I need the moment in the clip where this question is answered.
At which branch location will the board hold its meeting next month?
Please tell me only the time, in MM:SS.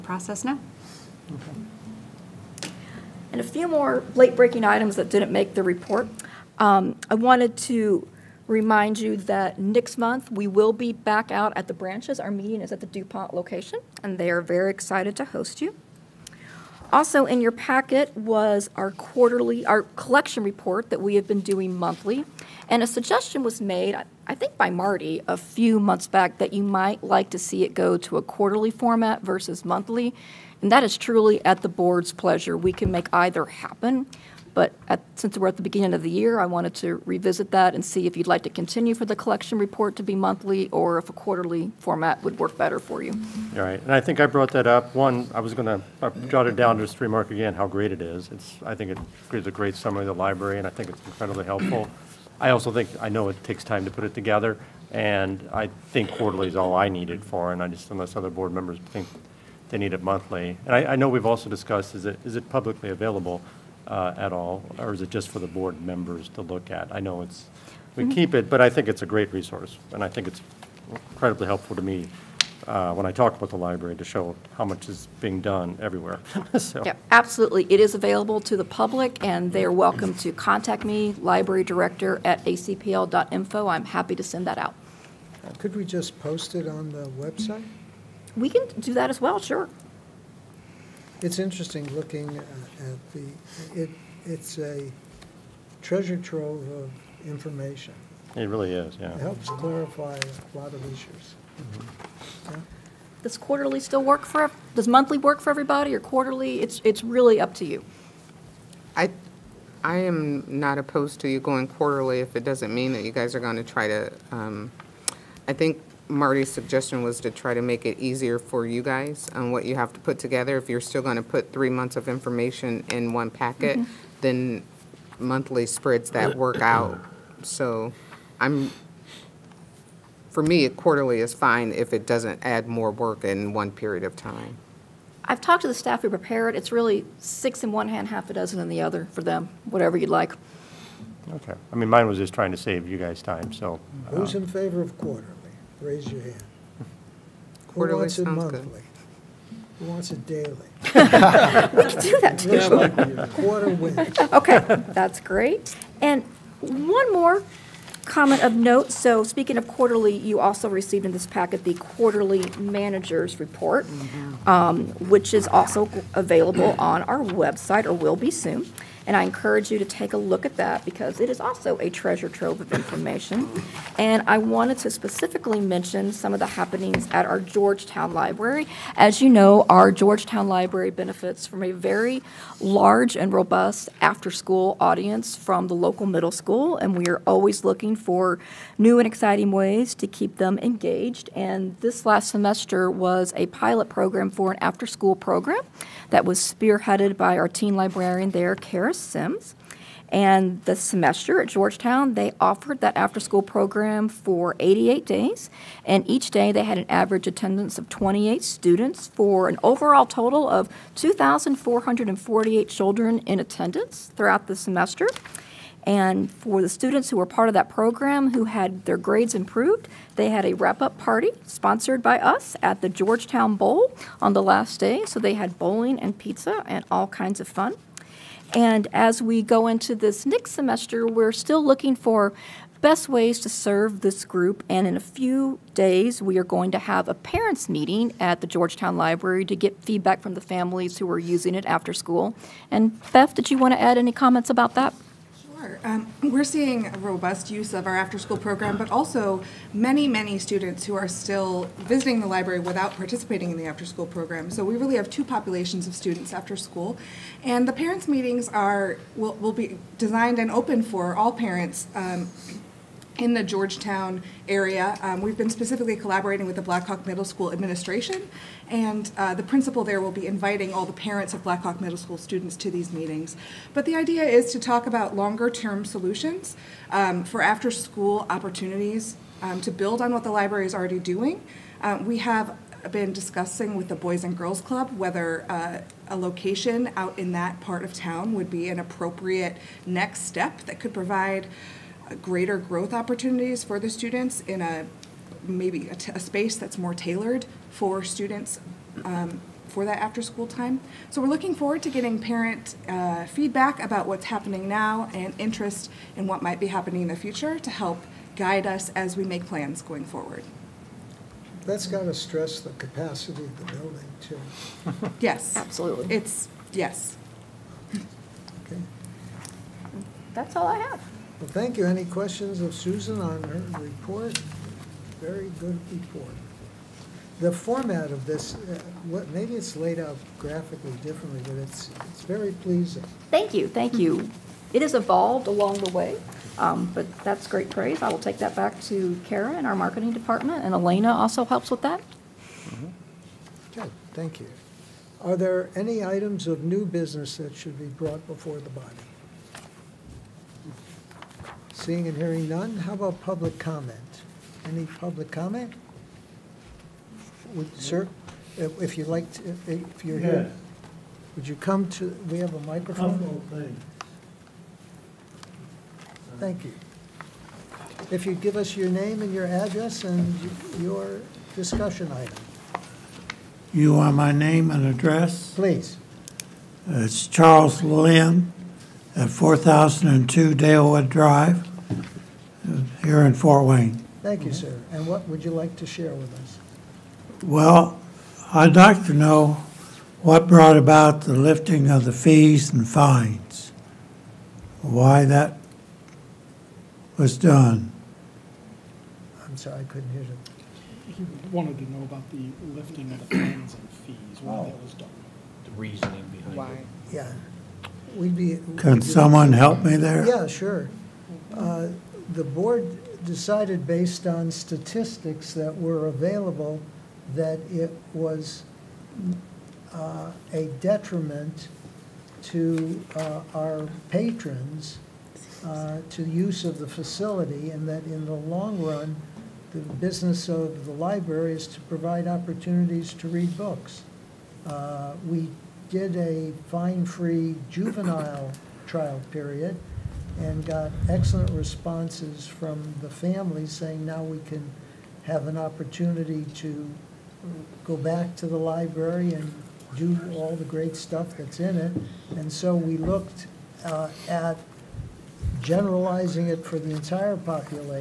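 00:12.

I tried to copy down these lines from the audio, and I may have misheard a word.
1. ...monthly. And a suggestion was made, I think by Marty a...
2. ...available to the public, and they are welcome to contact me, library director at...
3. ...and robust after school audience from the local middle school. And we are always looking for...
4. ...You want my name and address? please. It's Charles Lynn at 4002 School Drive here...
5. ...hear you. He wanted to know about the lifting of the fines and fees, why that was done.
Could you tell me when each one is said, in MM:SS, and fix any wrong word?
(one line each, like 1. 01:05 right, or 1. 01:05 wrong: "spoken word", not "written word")
1. 00:21 right
2. 01:17 right
3. 03:03 right
4. 06:13 wrong: "Dalewood", not "School"
5. 06:40 right.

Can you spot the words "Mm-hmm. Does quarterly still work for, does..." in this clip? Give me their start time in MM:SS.
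01:41.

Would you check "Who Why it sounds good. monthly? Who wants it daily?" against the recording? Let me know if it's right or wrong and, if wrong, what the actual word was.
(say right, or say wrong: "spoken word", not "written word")
wrong: "Quarterly", not "Why".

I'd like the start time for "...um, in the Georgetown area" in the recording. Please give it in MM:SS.
04:21.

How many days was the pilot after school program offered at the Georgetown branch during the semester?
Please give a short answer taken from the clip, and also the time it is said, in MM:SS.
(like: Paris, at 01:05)
88, at 03:24.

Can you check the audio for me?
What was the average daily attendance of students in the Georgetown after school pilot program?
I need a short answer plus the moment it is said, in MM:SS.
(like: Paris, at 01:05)
28, at 03:27.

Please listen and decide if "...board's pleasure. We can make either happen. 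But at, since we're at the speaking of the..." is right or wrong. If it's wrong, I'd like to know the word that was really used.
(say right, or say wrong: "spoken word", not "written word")
wrong: "beginning", not "speaking".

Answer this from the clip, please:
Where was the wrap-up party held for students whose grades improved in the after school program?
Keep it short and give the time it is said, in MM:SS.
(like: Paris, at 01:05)
Georgetown Bowl, at 03:42.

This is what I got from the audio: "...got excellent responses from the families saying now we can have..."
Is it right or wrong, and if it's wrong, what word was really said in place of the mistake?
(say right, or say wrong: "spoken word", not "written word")
right.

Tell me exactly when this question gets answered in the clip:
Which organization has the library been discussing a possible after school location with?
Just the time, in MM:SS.
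04:43.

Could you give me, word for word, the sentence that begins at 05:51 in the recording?
Seeing and hearing none, how about public comment?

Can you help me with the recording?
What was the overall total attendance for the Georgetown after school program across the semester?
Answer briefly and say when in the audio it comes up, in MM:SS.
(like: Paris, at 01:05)
2,448, at 03:30.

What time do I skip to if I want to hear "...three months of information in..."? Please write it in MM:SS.
02:01.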